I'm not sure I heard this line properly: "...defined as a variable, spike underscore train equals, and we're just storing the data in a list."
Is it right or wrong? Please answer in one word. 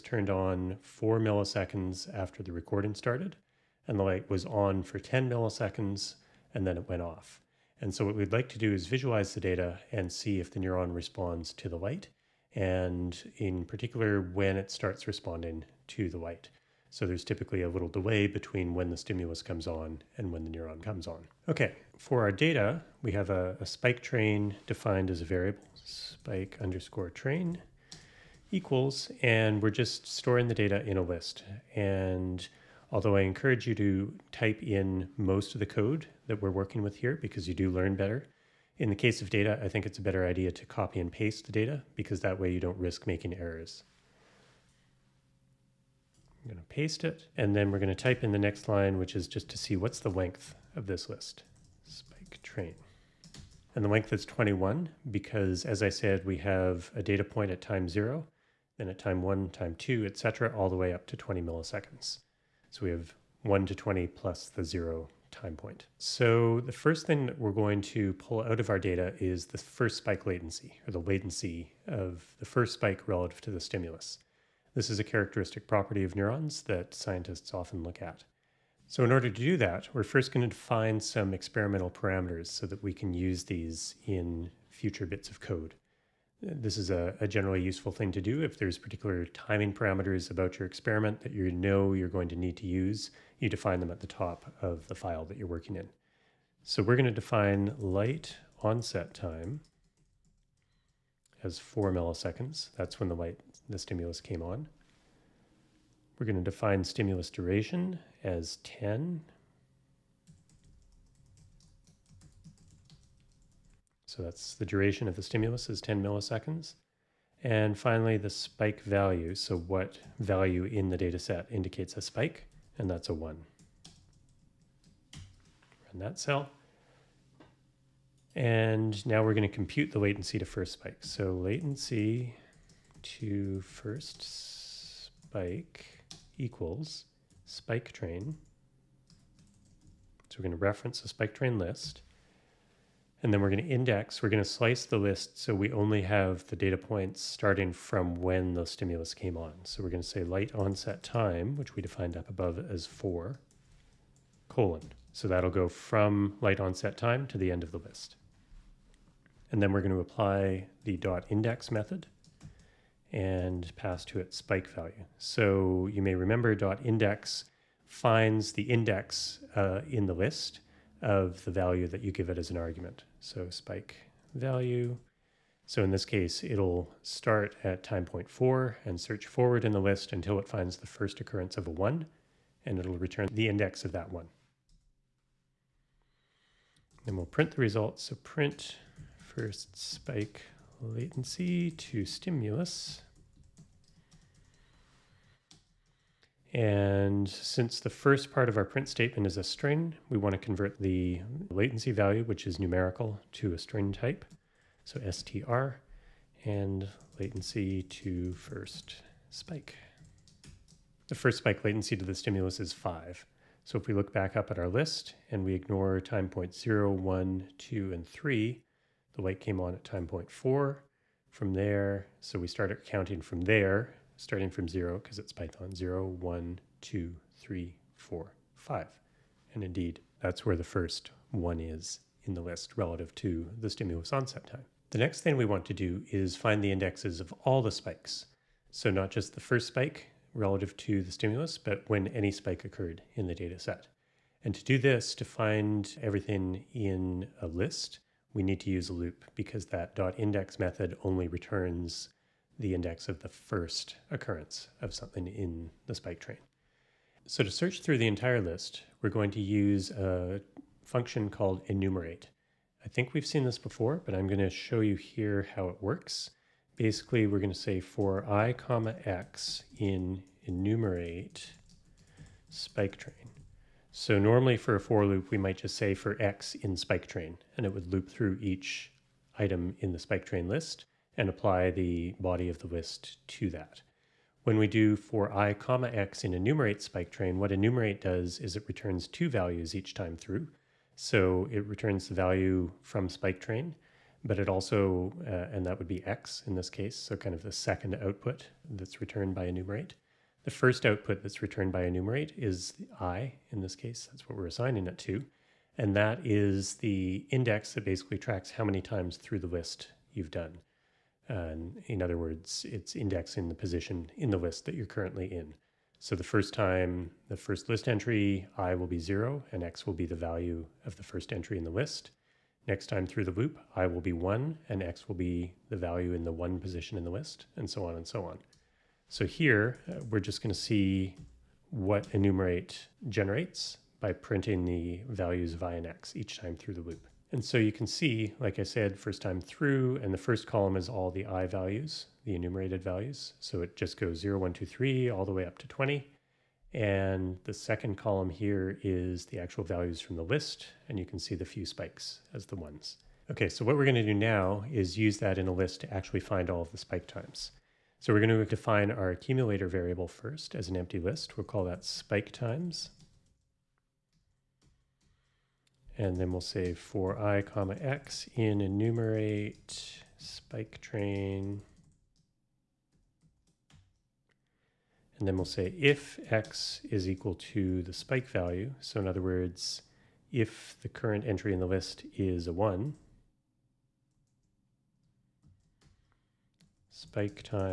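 right.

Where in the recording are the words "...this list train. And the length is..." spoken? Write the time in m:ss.
0:50.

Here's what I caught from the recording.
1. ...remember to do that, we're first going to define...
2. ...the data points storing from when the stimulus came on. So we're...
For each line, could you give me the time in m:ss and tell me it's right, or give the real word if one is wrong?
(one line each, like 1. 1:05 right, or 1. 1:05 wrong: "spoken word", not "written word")
1. 1:19 wrong: "order", not "remember"
2. 2:26 wrong: "starting", not "storing".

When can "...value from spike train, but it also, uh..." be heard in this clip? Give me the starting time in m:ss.
4:52.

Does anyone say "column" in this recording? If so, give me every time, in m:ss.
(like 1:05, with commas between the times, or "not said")
5:40, 5:47.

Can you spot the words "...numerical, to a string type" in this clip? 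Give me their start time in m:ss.
3:22.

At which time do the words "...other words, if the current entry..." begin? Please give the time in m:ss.
6:19.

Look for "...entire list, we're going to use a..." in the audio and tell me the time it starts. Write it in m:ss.
4:18.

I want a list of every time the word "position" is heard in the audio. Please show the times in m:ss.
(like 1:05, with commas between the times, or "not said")
5:13, 5:26.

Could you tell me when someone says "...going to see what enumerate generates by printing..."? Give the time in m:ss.
5:30.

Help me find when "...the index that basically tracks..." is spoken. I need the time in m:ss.
5:06.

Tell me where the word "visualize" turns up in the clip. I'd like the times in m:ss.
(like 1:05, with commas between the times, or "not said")
0:08.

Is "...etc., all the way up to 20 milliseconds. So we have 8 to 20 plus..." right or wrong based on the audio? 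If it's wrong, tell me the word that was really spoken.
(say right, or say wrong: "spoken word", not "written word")
wrong: "1", not "8".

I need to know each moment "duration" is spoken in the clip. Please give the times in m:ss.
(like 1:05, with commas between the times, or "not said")
1:47, 1:54.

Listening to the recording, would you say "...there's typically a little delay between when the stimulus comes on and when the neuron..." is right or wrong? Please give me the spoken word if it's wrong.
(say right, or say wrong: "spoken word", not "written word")
right.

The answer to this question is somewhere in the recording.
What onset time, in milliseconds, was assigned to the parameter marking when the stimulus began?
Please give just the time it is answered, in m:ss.
1:41.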